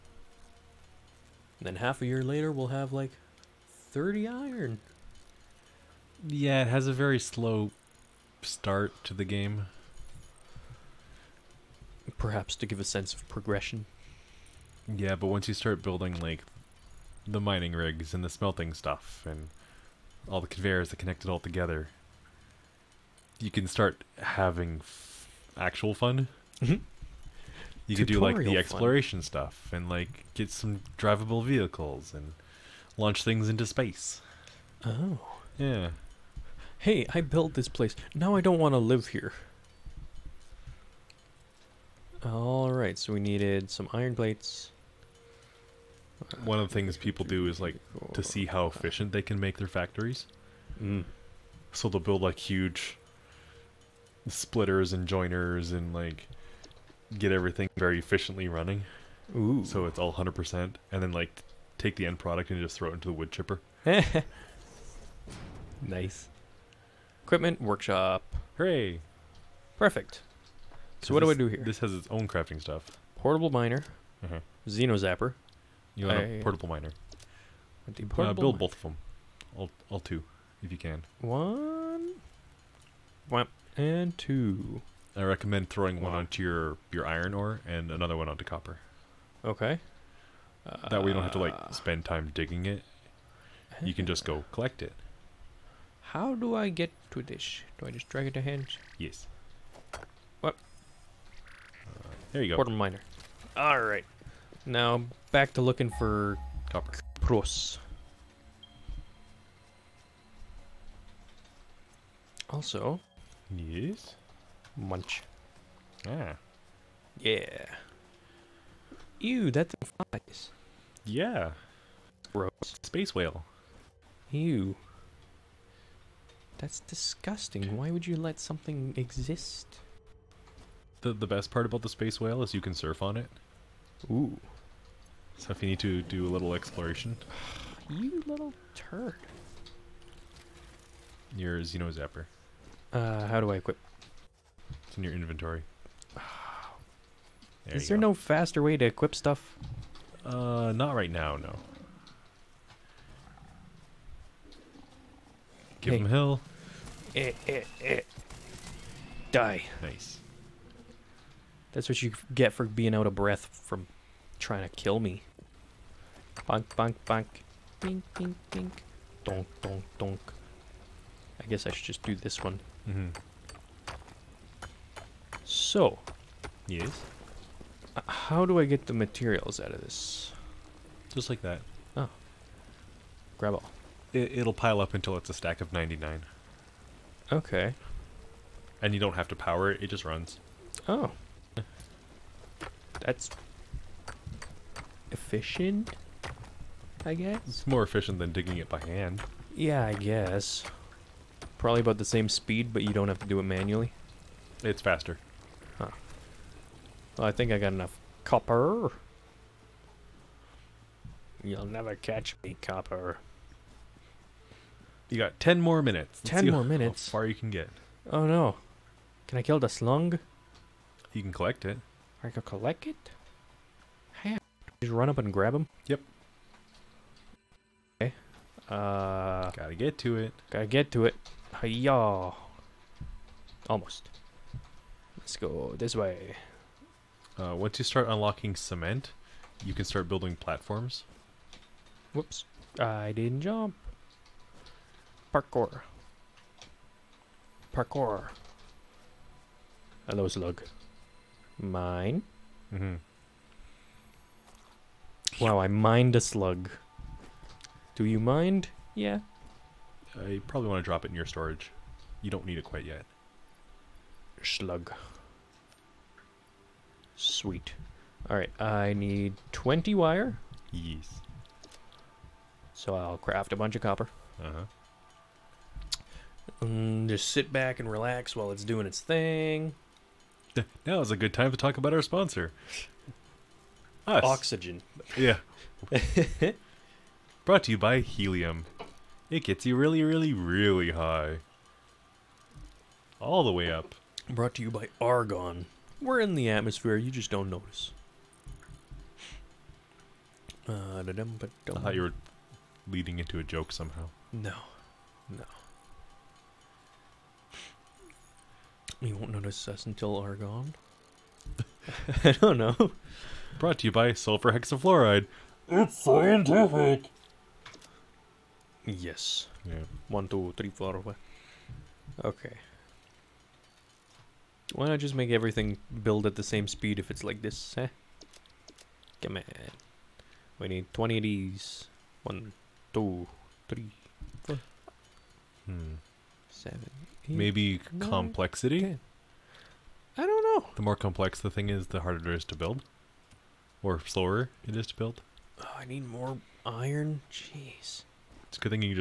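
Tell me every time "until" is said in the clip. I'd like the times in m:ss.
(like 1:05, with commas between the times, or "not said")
3:04, 5:09.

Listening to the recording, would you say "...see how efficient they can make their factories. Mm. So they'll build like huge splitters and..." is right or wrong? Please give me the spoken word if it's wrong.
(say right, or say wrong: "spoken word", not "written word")
right.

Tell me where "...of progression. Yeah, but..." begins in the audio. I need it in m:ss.
0:13.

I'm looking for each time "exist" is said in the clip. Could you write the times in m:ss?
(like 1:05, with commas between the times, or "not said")
2:08.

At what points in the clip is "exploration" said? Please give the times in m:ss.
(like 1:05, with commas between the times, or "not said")
0:28, 2:16.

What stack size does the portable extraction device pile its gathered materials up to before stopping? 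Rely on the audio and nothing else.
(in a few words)
99.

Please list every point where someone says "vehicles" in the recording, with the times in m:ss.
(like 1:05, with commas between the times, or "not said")
0:31.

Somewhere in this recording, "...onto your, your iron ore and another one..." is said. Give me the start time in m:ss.
1:26.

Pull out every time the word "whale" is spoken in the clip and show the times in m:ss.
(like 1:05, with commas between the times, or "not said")
2:03, 2:12.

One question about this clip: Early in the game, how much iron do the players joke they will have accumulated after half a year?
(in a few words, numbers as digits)
30.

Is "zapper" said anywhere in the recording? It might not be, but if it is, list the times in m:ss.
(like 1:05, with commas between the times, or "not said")
1:14, 2:21.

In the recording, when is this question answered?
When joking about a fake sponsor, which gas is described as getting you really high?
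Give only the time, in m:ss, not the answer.
4:48.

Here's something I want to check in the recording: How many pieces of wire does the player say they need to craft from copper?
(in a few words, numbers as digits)
20.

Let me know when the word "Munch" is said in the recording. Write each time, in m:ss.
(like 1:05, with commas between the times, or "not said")
1:54.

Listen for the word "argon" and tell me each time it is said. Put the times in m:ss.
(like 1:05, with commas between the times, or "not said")
4:55, 5:10.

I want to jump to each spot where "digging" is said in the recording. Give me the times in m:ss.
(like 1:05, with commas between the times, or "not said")
1:32, 3:18.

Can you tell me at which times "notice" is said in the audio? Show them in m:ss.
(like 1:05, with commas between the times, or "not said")
4:57, 5:09.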